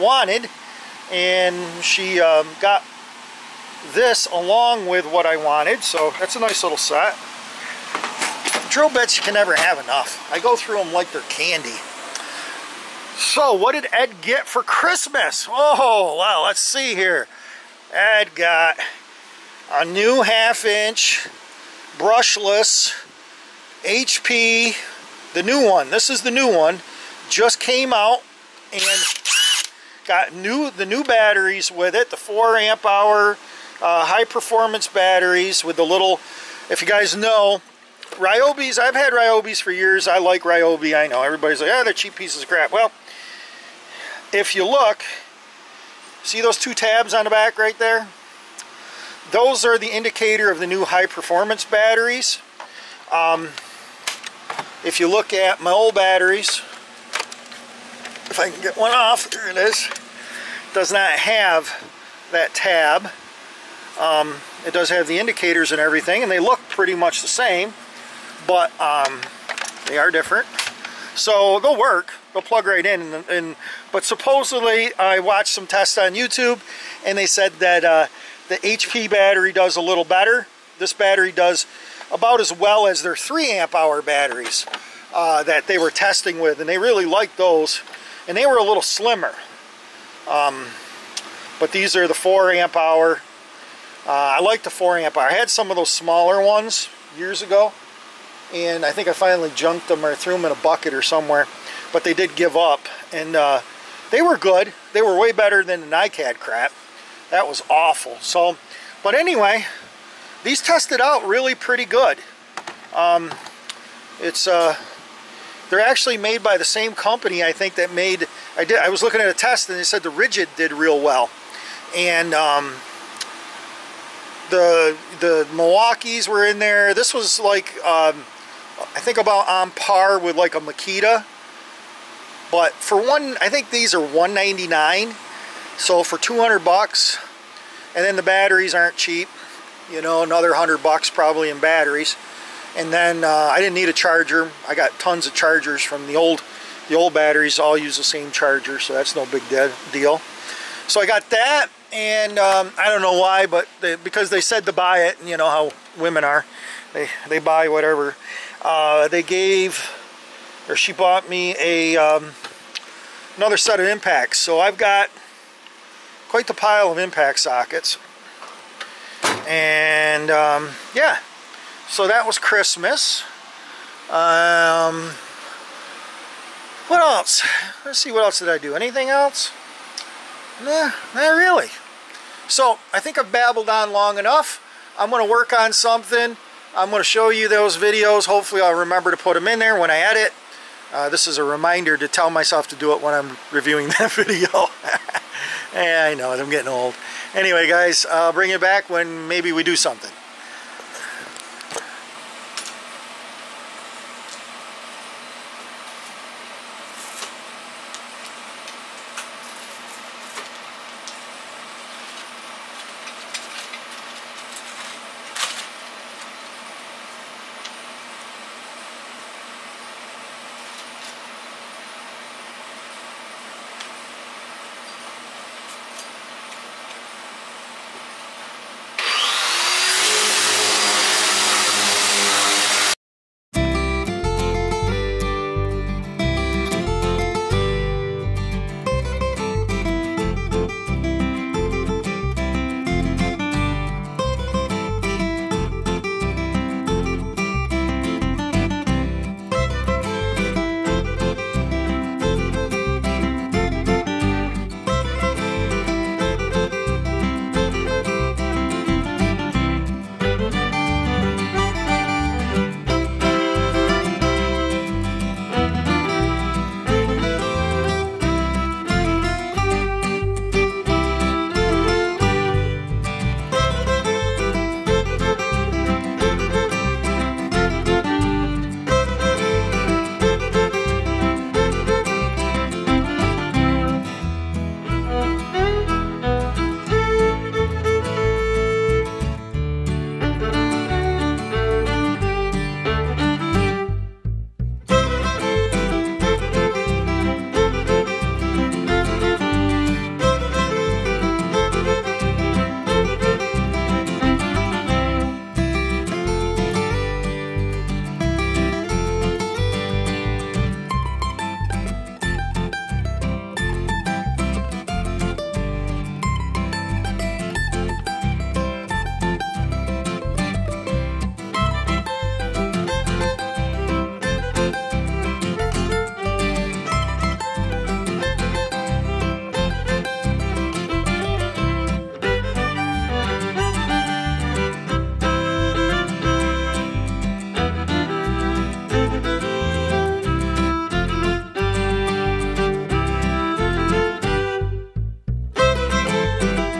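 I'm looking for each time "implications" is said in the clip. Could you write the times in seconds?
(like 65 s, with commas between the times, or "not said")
not said.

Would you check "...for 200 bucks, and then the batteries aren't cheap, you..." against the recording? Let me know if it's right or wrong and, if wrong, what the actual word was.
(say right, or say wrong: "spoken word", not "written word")
right.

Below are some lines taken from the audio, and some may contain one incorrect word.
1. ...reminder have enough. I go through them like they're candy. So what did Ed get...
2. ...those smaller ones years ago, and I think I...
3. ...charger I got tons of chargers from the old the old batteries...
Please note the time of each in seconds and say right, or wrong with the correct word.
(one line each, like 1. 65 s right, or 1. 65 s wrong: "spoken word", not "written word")
1. 9 s wrong: "never", not "reminder"
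2. 95 s right
3. 143 s right.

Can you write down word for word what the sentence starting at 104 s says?
They were way better than the NICAD crap.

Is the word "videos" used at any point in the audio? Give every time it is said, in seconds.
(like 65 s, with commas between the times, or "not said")
187 s, 194 s.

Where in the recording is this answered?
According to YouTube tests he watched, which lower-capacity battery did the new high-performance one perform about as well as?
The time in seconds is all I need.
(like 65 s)
83 s.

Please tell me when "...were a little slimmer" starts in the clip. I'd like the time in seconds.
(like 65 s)
88 s.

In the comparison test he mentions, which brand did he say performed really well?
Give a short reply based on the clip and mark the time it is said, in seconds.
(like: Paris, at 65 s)
Ridgid, at 120 s.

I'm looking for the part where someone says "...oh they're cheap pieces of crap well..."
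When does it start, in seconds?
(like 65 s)
41 s.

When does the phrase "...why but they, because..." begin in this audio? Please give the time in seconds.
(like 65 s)
153 s.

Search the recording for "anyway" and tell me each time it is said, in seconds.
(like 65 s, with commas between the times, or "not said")
109 s, 197 s.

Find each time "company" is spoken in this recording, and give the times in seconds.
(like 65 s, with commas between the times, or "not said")
116 s.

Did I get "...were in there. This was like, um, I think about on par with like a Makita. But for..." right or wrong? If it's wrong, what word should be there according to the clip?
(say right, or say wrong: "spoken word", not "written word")
right.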